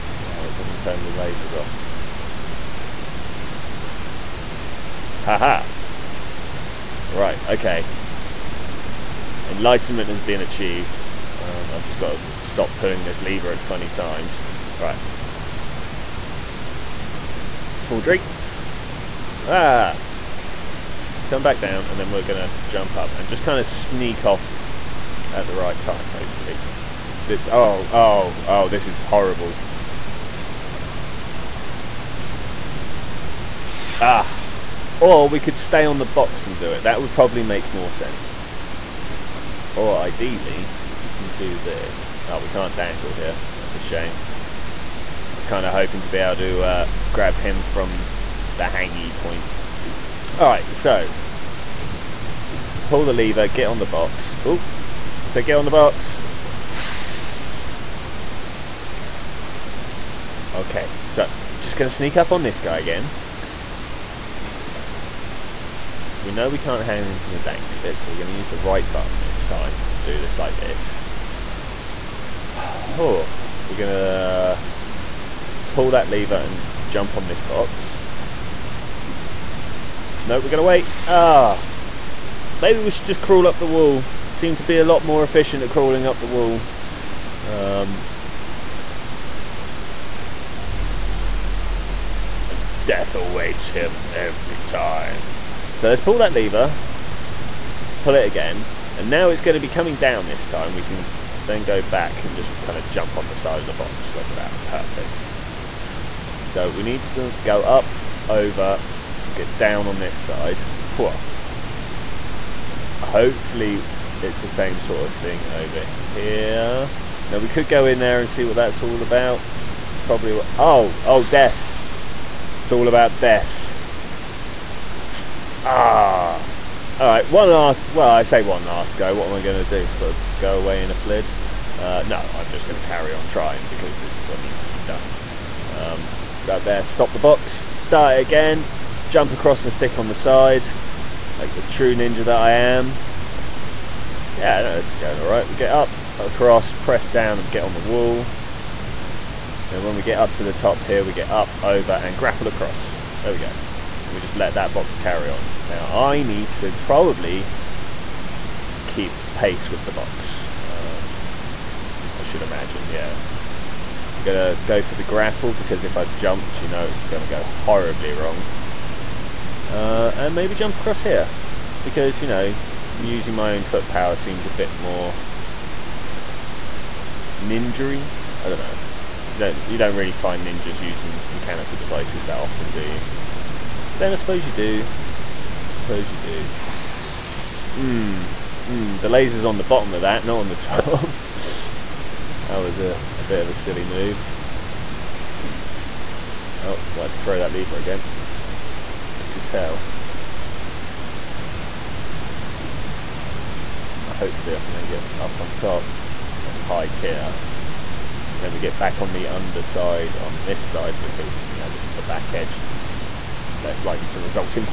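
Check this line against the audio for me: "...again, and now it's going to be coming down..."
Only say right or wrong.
right.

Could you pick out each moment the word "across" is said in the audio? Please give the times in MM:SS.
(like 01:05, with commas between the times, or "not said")
02:19, 02:26, 02:32, 02:50.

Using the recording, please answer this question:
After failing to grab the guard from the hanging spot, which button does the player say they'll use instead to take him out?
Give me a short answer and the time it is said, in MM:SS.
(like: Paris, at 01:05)
the right button, at 01:08.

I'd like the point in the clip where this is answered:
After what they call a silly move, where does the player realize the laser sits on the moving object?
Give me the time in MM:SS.
03:09.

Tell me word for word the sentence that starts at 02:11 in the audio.
Uh, no, I'm just going to carry on trying because this is what needs to be done.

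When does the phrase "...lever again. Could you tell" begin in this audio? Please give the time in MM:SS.
03:17.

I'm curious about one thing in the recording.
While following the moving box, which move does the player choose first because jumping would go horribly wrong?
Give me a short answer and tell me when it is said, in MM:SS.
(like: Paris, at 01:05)
the grapple, at 02:44.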